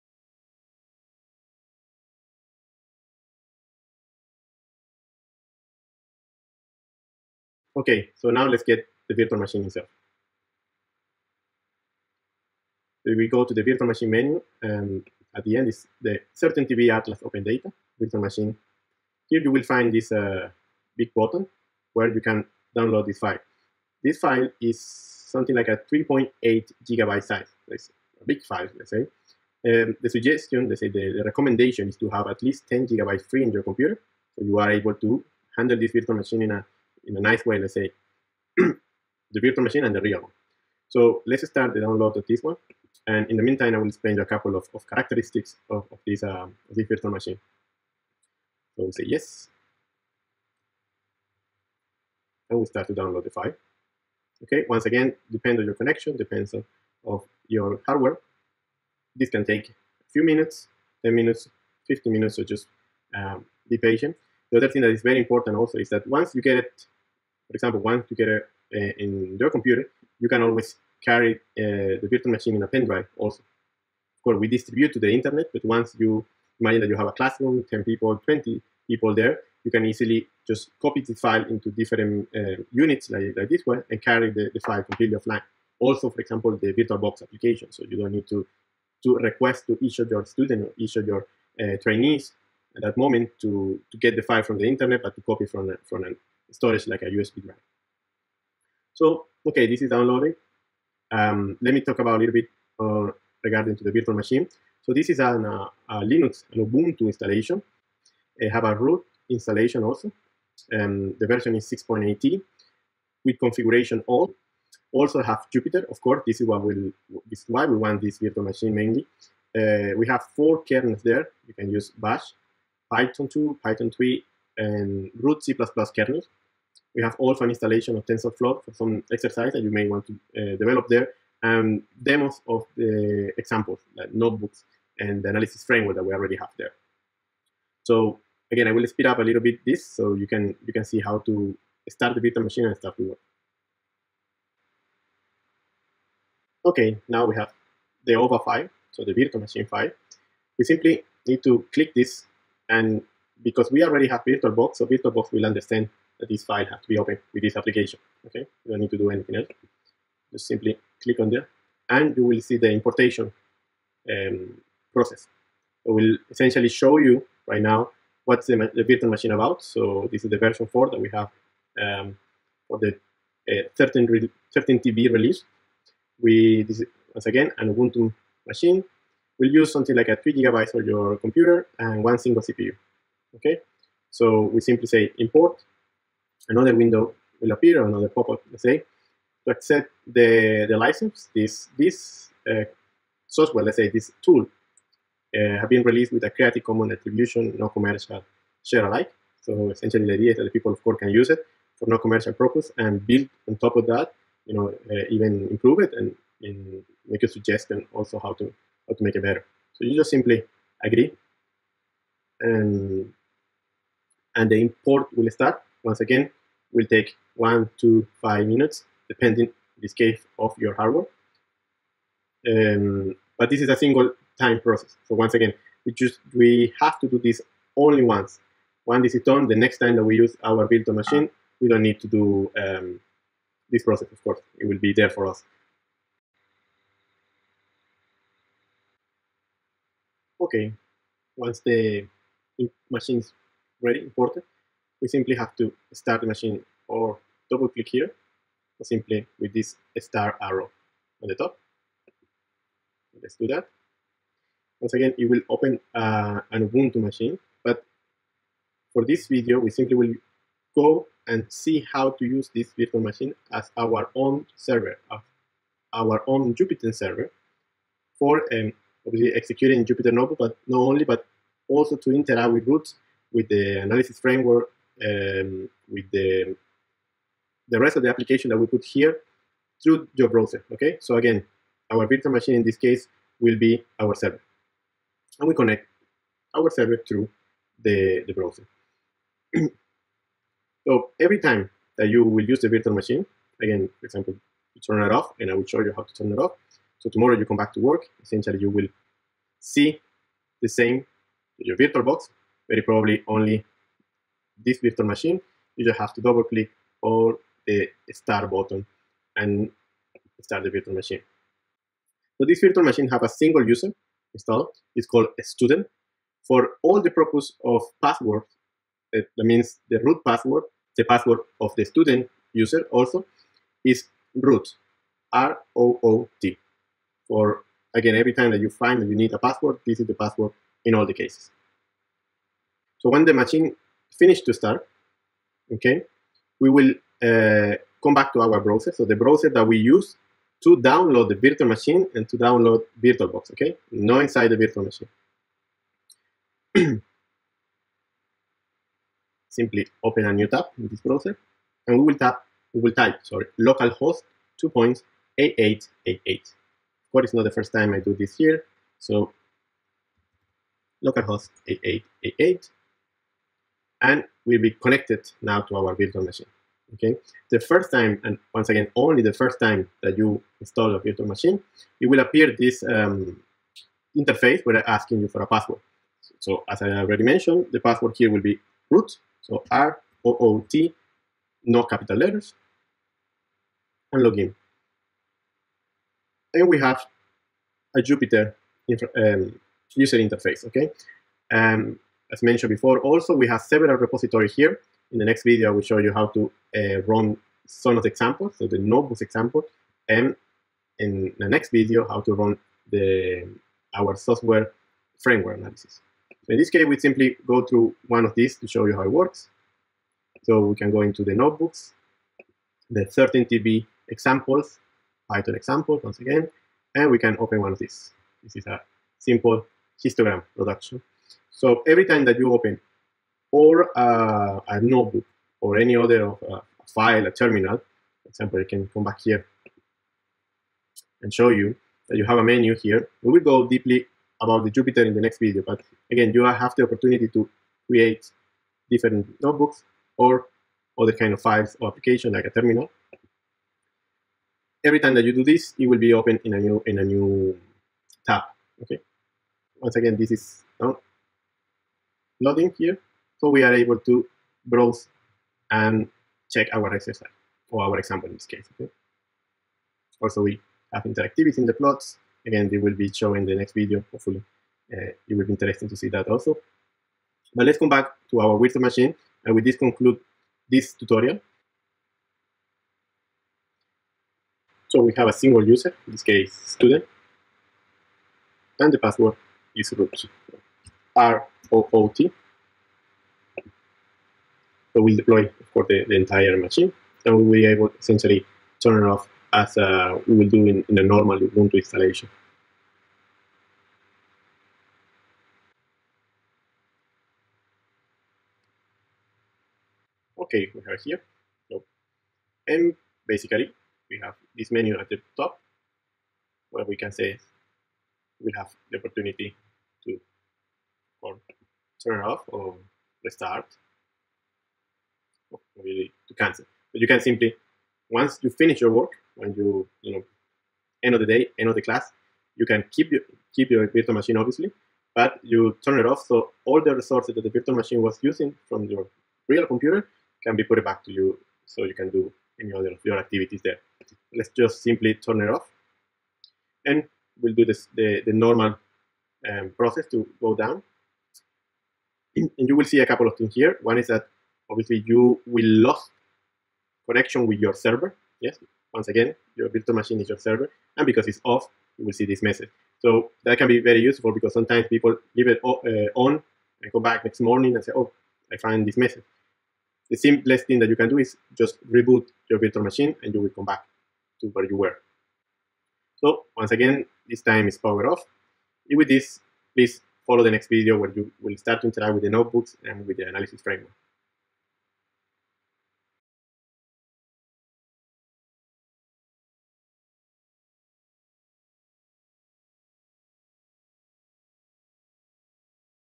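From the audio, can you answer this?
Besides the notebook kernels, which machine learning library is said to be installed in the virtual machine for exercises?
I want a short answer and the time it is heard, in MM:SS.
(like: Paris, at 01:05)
TensorFlow, at 02:08.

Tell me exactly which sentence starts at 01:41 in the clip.
Um, let me talk about a little bit uh, regarding to the virtual machine.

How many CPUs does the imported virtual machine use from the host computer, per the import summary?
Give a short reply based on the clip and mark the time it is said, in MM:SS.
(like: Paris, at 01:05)
1, at 03:02.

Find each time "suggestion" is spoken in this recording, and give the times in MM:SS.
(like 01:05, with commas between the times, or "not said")
00:30, 03:27.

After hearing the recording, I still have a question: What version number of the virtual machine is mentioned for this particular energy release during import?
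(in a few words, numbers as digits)
4.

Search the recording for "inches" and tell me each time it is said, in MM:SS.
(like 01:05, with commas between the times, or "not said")
not said.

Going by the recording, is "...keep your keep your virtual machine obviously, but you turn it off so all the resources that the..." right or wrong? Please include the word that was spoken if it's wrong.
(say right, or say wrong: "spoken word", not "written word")
right.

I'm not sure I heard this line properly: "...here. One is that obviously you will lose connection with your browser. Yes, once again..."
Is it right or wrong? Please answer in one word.
wrong.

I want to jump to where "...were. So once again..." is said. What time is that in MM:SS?
09:24.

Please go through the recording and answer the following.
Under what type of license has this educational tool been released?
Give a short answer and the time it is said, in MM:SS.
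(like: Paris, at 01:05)
Creative Commons, at 03:16.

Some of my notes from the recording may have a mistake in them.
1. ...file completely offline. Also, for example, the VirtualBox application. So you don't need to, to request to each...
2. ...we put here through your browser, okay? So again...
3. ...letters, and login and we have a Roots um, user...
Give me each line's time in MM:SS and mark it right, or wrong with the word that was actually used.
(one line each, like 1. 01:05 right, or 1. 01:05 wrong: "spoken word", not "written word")
1. 01:24 right
2. 04:38 right
3. 06:22 wrong: "Jupyter", not "Roots".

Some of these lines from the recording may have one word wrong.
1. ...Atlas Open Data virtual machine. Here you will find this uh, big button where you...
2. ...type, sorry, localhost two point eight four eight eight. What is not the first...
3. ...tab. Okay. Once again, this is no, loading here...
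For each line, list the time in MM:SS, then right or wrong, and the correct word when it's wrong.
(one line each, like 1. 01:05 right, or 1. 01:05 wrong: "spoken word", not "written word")
1. 00:16 right
2. 05:52 wrong: "eight", not "four"
3. 07:28 right.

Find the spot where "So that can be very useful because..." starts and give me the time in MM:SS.
09:12.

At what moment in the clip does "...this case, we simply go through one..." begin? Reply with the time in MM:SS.
06:46.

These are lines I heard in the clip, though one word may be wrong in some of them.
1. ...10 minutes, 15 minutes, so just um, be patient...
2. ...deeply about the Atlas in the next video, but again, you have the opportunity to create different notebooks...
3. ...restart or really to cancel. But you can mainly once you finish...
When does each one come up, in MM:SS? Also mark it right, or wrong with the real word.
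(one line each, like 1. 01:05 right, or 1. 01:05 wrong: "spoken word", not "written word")
1. 01:01 right
2. 07:13 wrong: "Jupyter", not "Atlas"
3. 08:33 wrong: "simply", not "mainly".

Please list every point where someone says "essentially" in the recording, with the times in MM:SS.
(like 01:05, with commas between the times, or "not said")
02:46, 03:19, 04:58, 08:07.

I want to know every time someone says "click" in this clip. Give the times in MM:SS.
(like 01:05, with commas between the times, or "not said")
02:31, 02:41, 04:07, 05:06.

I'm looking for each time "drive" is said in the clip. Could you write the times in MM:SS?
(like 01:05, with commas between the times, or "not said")
01:12, 01:37.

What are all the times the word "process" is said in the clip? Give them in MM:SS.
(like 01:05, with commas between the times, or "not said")
02:44, 03:44, 03:53, 08:59.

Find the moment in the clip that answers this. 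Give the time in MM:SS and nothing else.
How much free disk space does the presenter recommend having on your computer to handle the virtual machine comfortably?
00:32.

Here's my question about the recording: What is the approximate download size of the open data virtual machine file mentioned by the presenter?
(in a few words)
3.8 gigabytes.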